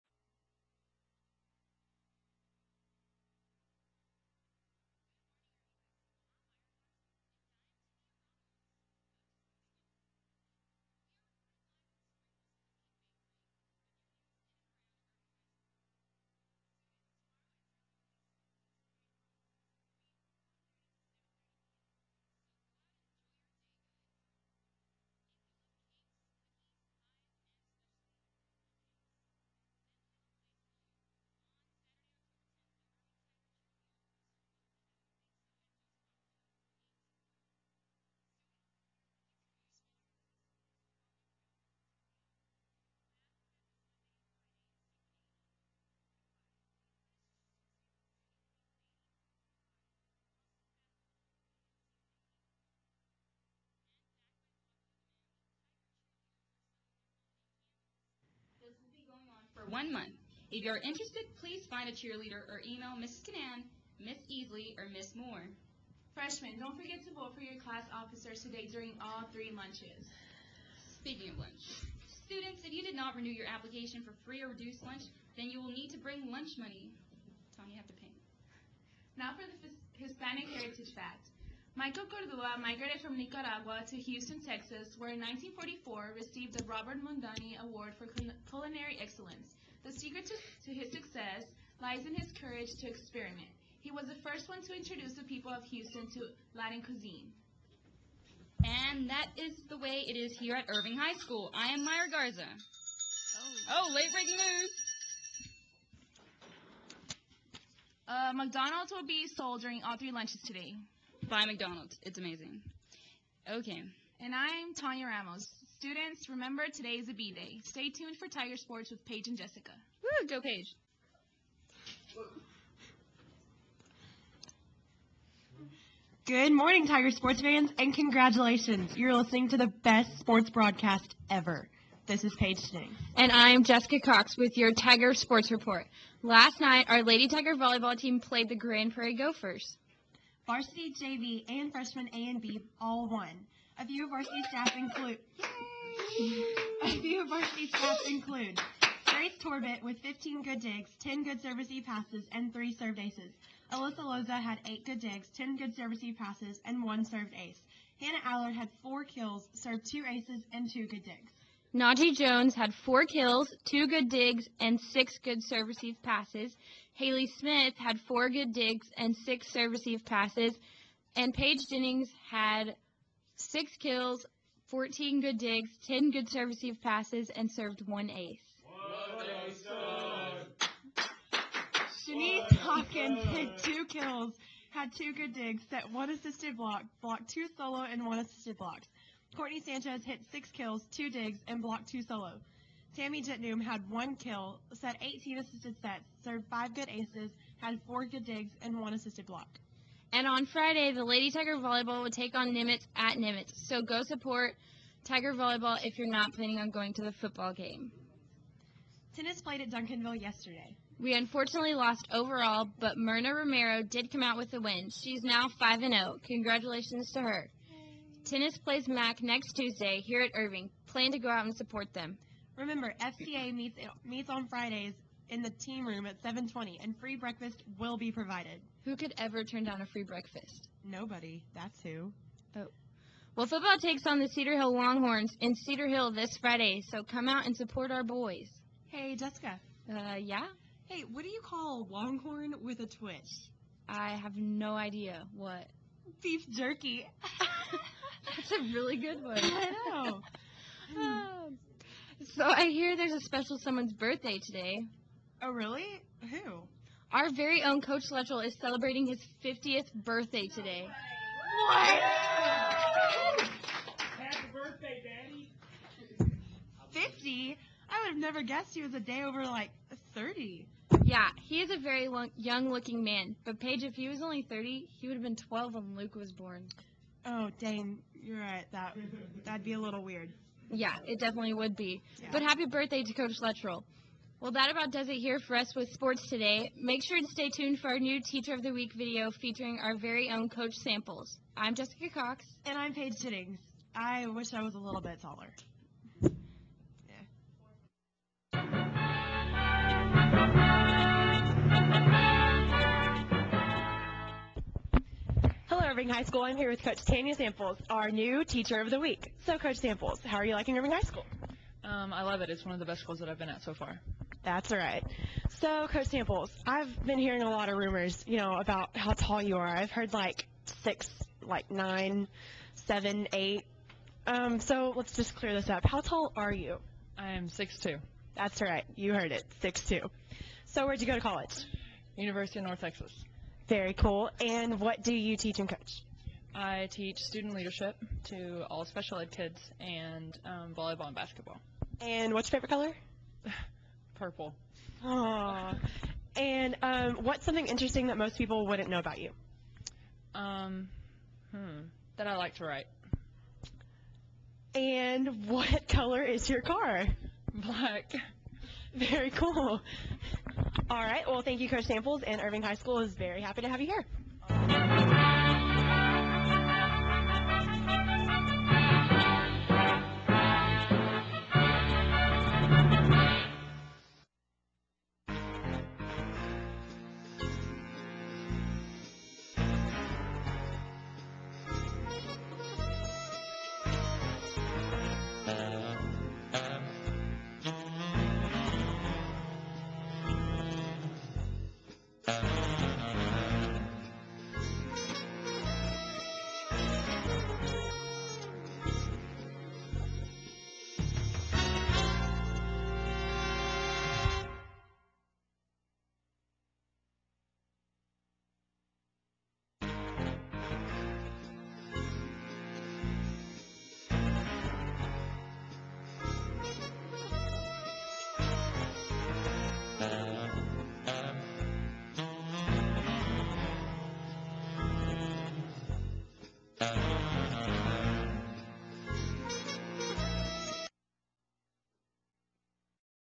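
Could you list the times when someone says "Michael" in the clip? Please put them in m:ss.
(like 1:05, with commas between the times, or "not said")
1:21.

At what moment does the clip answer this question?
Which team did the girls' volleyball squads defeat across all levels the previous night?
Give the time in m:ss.
2:18.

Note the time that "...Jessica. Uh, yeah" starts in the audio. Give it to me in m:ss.
3:59.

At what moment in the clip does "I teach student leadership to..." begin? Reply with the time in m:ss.
5:36.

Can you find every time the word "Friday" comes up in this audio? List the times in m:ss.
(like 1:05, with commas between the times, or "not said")
3:20, 3:44, 3:56.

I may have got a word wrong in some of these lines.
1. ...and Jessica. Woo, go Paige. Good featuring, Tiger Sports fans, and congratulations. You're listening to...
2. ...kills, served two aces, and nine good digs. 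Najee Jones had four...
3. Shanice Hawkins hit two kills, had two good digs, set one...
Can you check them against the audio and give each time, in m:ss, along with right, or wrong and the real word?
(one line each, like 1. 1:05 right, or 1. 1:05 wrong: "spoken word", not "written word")
1. 1:59 wrong: "morning", not "featuring"
2. 2:39 wrong: "two", not "nine"
3. 3:02 right.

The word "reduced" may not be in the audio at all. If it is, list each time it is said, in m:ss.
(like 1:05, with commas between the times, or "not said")
1:14.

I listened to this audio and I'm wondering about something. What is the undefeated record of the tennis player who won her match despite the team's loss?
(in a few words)
5 and 0.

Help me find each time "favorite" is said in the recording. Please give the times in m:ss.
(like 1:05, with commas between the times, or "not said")
5:42.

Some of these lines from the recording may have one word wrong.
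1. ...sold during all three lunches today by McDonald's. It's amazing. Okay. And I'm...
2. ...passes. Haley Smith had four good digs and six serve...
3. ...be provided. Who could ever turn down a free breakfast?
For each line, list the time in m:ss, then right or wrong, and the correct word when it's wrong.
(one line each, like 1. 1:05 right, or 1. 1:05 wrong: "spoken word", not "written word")
1. 1:49 right
2. 2:46 right
3. 3:47 right.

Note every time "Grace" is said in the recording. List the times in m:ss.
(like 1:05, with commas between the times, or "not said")
2:29.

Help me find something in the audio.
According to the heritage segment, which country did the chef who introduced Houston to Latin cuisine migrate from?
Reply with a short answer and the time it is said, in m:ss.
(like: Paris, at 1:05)
Nicaragua, at 1:23.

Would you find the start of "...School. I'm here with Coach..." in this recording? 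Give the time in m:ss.
5:06.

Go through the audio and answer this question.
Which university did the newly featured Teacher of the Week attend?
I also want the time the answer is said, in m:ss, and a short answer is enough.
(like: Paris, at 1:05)
University of North Texas, at 5:32.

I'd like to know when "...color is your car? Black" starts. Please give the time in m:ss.
5:55.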